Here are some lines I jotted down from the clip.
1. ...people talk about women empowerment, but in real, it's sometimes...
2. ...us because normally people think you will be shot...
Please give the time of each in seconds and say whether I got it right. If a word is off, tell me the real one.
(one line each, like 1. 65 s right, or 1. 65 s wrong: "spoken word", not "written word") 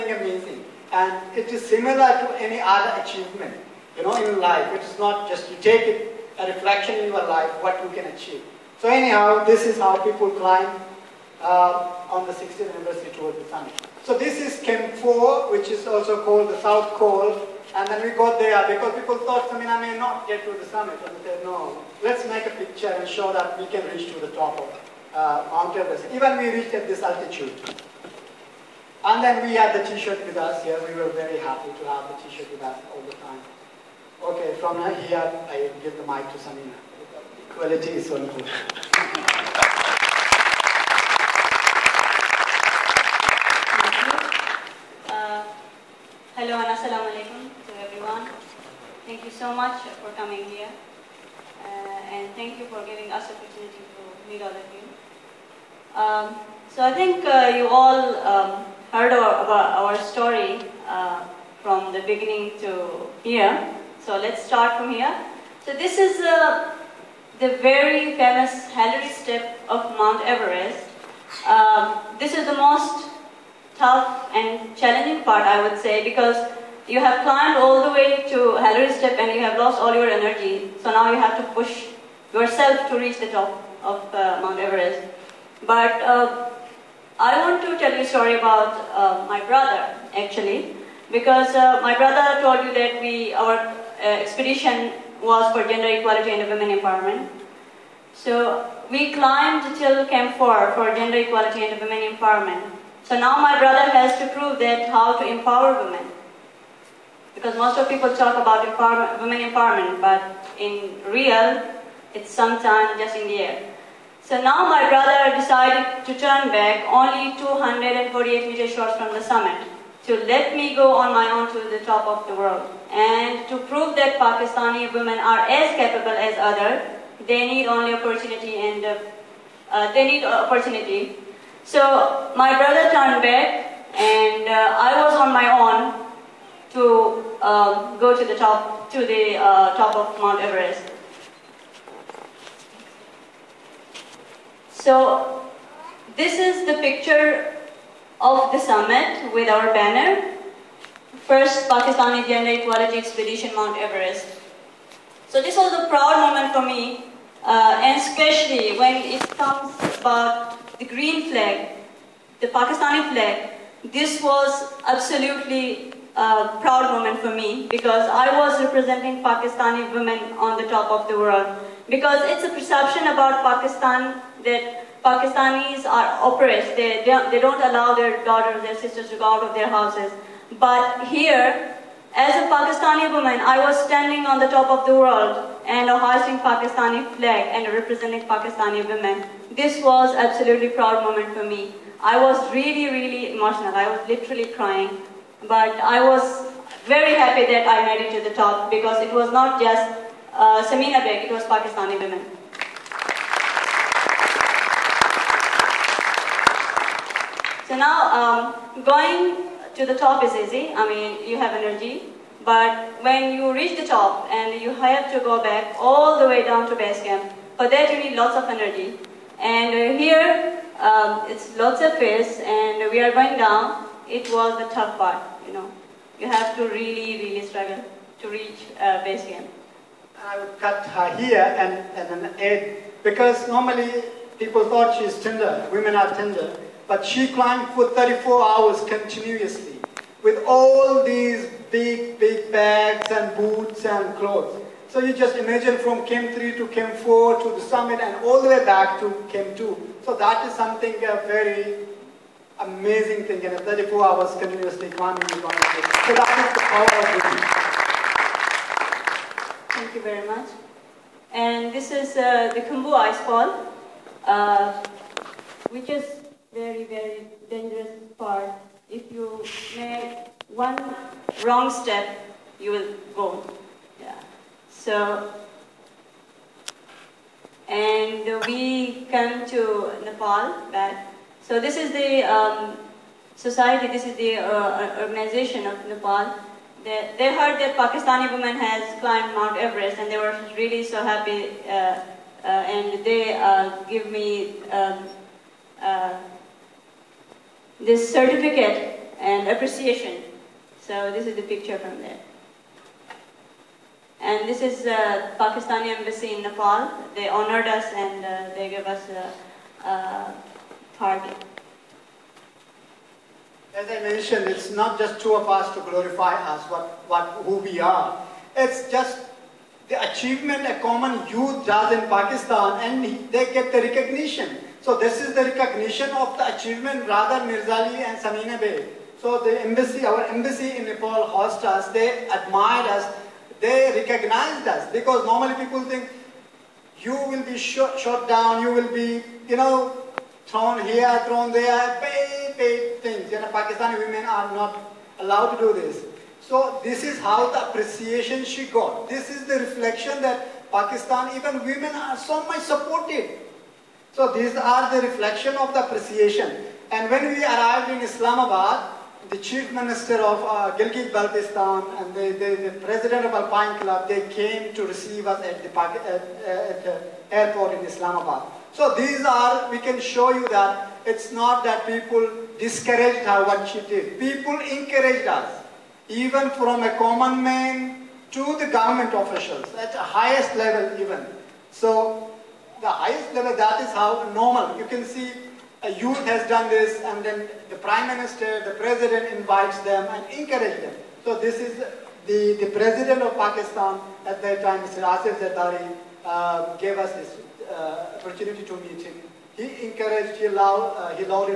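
1. 107 s right
2. 334 s right.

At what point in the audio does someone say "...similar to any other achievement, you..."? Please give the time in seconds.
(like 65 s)
1 s.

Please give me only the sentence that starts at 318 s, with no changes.
It's just the achievement a common youth does in Pakistan and they get the recognition.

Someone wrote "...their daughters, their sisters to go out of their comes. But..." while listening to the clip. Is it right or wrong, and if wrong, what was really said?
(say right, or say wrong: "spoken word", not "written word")
wrong: "houses", not "comes".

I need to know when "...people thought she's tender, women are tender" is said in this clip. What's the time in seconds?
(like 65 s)
234 s.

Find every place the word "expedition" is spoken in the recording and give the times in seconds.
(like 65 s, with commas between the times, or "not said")
94 s, 153 s.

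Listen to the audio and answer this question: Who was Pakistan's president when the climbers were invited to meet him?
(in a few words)
Asif Zardari.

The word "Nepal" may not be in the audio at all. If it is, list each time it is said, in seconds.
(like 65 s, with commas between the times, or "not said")
280 s, 285 s, 306 s, 330 s.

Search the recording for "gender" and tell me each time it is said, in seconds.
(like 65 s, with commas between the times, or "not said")
95 s, 100 s, 151 s.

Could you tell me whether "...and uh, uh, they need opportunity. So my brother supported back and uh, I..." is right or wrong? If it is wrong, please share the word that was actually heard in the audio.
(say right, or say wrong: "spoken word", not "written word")
wrong: "turned", not "supported".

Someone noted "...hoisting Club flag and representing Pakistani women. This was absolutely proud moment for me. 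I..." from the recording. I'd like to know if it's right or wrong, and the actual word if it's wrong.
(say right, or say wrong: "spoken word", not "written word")
wrong: "Pakistani", not "Club".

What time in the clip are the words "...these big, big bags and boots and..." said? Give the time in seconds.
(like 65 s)
241 s.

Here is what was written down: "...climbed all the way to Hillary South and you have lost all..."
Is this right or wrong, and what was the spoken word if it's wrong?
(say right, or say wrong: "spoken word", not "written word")
wrong: "Step", not "South".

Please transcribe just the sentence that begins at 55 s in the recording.
Um, so I think uh, you all um, heard our, about our story uh, from the beginning to here.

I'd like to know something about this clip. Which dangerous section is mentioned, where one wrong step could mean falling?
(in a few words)
Khumbu Icefall.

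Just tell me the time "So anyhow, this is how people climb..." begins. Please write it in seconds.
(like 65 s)
8 s.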